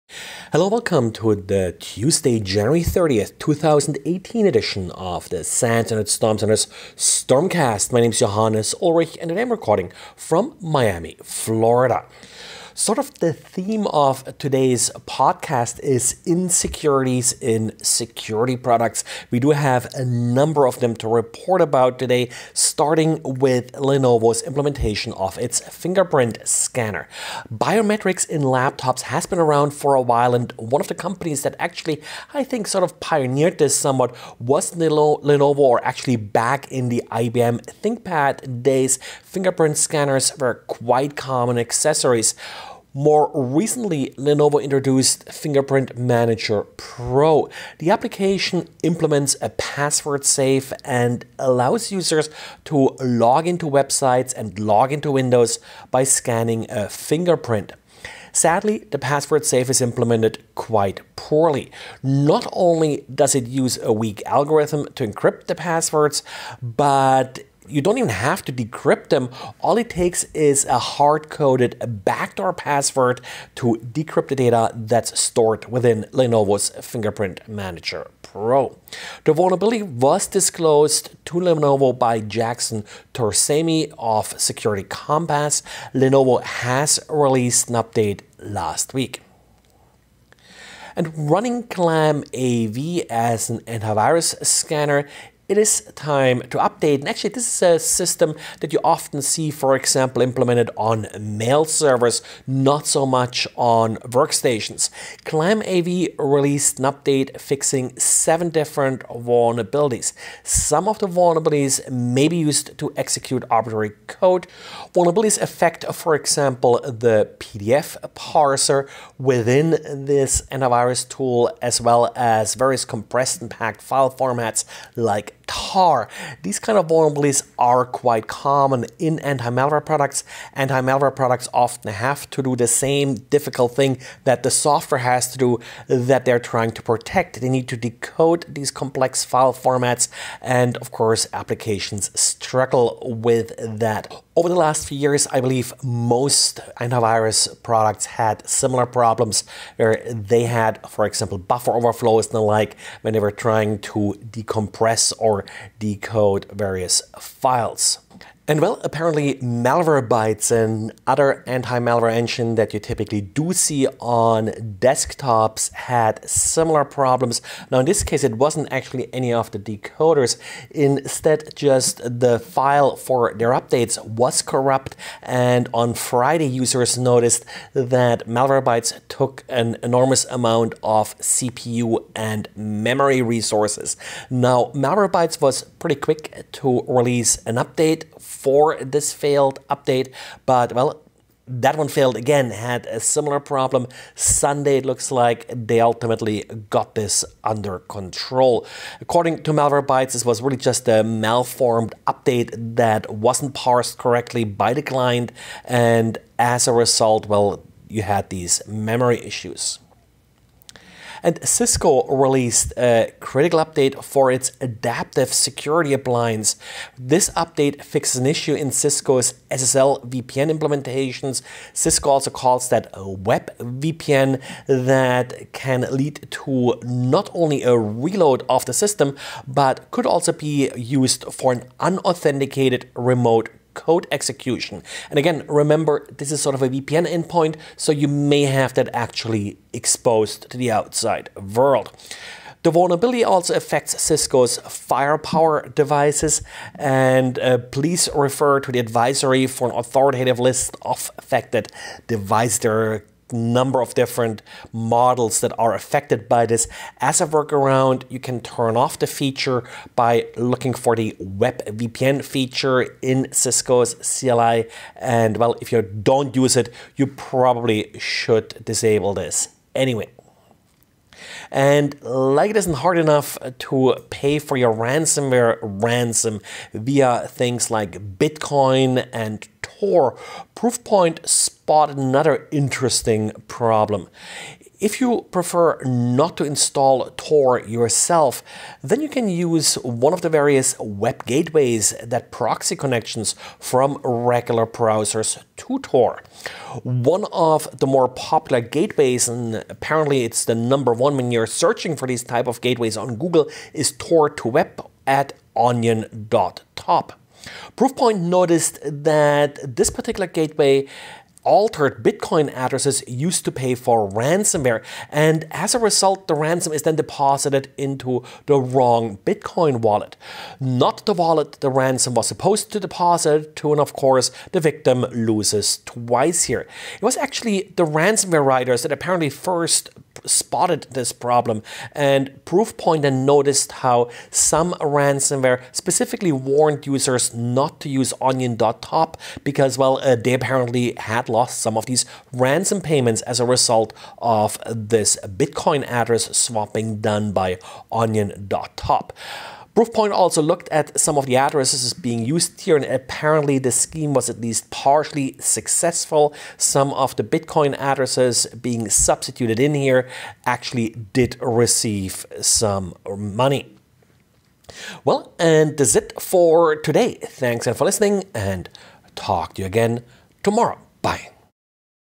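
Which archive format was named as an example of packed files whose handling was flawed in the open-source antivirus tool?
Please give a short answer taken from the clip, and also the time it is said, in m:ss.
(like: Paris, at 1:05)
tar, at 2:05.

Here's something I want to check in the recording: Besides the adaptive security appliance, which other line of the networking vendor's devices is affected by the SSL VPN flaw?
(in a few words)
Firepower.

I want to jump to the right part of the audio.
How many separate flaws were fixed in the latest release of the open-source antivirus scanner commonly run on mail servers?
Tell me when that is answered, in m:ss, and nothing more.
1:47.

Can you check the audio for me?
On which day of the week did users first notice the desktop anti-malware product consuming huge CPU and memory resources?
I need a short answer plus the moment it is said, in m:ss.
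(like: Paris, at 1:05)
Friday, at 2:55.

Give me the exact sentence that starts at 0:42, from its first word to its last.
More recently, Lenovo introduced Fingerprint Manager Pro.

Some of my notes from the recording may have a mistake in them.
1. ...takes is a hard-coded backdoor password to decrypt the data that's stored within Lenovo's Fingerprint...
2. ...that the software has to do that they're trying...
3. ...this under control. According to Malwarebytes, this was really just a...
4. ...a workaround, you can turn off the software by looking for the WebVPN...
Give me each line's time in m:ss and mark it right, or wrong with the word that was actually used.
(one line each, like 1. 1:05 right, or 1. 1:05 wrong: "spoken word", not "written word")
1. 1:09 right
2. 2:14 right
3. 3:16 right
4. 4:17 wrong: "feature", not "software".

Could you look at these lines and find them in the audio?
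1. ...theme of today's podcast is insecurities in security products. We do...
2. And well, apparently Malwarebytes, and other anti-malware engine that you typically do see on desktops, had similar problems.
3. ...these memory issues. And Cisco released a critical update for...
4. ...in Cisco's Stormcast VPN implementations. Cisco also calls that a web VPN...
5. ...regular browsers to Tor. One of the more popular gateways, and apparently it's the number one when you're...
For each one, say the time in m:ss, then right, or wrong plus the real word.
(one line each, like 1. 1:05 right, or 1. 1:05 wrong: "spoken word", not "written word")
1. 0:13 right
2. 2:38 right
3. 3:28 right
4. 3:38 wrong: "SSL", not "Stormcast"
5. 4:54 right.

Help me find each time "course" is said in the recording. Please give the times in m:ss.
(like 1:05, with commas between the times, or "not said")
2:20, 5:23.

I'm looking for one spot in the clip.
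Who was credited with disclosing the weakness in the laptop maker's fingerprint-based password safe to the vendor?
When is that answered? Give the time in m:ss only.
1:22.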